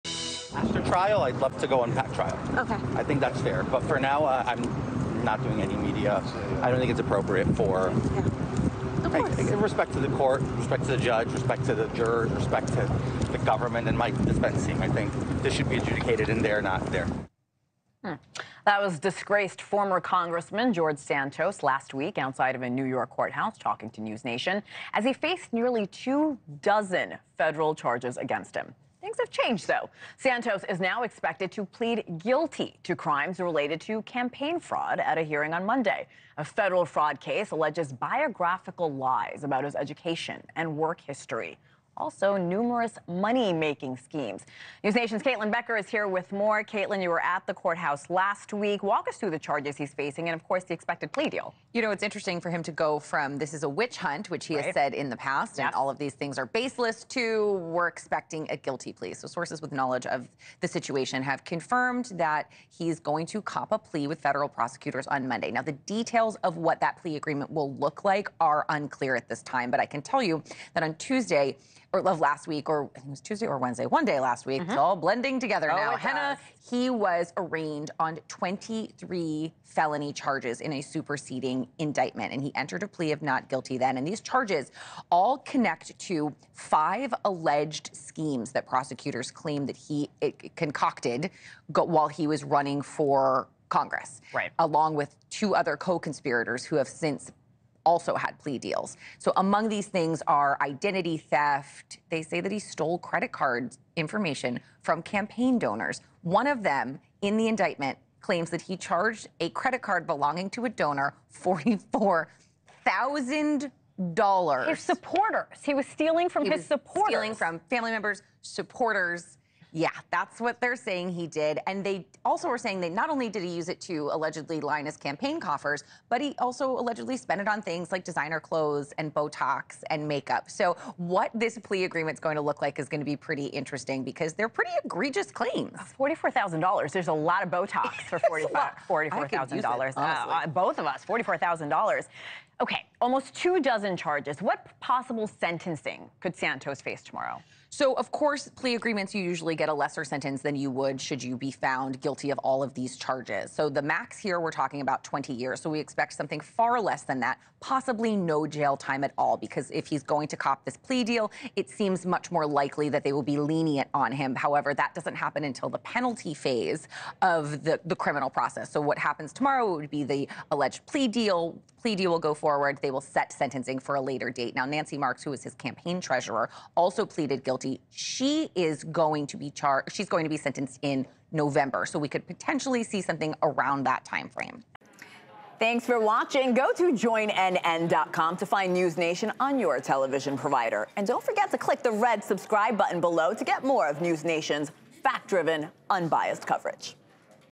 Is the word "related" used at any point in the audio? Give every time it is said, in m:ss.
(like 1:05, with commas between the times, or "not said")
0:33.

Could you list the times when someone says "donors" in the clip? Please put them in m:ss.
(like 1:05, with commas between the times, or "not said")
1:45, 1:50.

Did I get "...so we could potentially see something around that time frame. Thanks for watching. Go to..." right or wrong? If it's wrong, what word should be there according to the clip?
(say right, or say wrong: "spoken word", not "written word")
right.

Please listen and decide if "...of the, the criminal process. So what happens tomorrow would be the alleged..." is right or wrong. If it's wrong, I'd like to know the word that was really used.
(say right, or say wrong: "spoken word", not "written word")
right.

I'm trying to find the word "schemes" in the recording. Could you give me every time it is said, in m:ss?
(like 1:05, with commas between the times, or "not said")
0:43, 1:28.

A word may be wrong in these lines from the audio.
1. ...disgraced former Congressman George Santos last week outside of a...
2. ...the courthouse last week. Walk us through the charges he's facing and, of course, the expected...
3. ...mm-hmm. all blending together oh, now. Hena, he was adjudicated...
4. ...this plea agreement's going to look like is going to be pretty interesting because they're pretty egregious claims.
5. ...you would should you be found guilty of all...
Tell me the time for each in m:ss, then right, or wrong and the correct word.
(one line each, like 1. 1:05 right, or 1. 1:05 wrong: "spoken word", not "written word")
1. 0:18 right
2. 0:47 right
3. 1:14 wrong: "arraigned", not "adjudicated"
4. 2:11 right
5. 2:30 right.